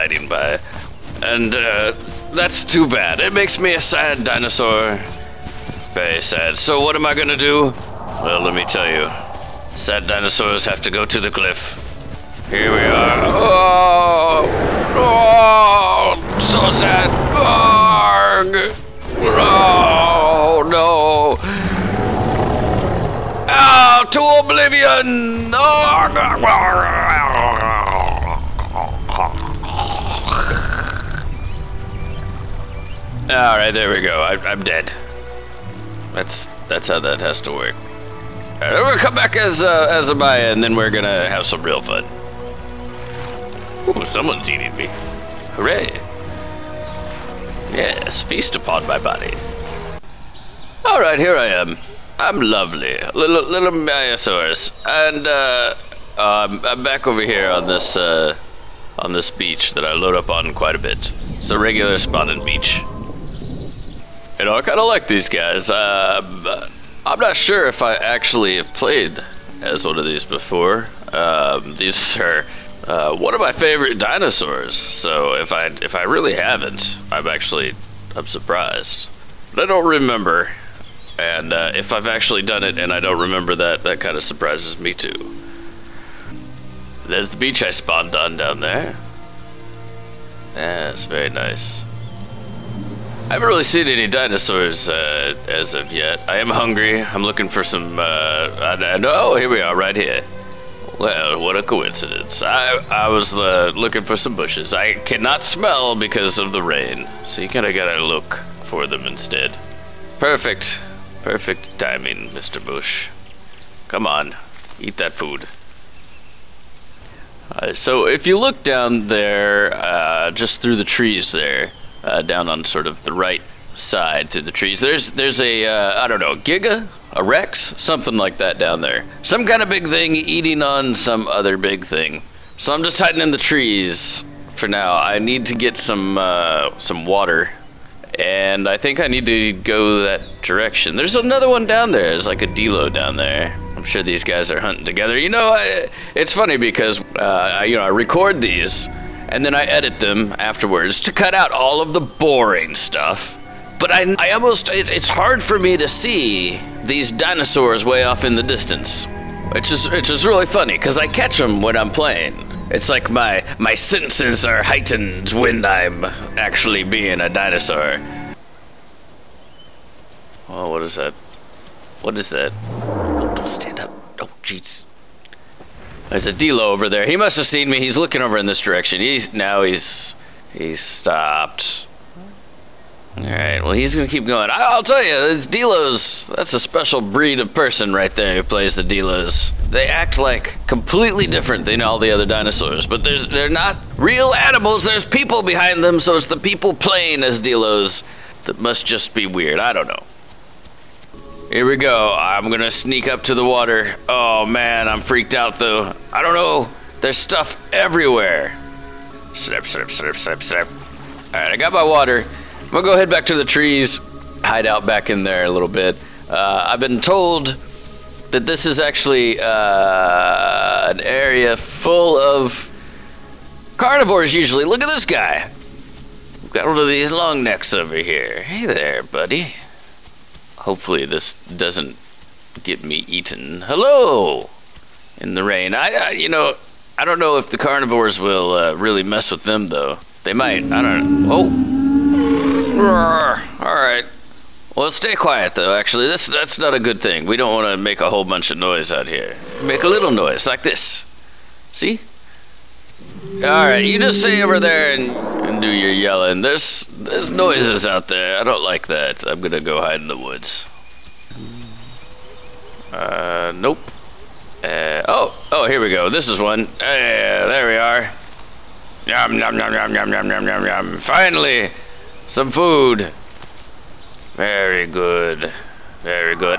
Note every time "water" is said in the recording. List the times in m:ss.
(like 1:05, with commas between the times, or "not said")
2:17, 3:23, 3:31.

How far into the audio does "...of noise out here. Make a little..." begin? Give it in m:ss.
4:08.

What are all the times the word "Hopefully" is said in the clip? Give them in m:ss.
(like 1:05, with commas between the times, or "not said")
3:50.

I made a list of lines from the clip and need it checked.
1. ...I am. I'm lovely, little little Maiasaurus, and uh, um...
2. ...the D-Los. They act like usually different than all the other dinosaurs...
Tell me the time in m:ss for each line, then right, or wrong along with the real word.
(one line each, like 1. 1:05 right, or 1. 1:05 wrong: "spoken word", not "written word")
1. 0:51 right
2. 3:08 wrong: "completely", not "usually".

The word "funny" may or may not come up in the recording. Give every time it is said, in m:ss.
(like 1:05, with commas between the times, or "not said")
2:26, 2:40.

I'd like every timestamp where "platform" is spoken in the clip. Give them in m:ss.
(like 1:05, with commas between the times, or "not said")
not said.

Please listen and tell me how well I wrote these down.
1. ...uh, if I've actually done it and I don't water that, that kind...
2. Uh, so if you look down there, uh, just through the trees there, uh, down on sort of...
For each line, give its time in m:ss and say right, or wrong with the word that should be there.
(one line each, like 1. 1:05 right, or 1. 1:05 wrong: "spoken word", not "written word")
1. 1:21 wrong: "remember", not "water"
2. 1:57 right.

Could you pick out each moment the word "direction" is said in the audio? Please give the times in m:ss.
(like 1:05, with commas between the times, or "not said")
2:20, 2:58.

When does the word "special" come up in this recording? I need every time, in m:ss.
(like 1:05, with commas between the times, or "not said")
3:06.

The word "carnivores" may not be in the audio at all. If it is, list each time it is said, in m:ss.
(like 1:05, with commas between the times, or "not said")
3:43, 3:57.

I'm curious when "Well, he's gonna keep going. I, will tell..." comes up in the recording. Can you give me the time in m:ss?
3:03.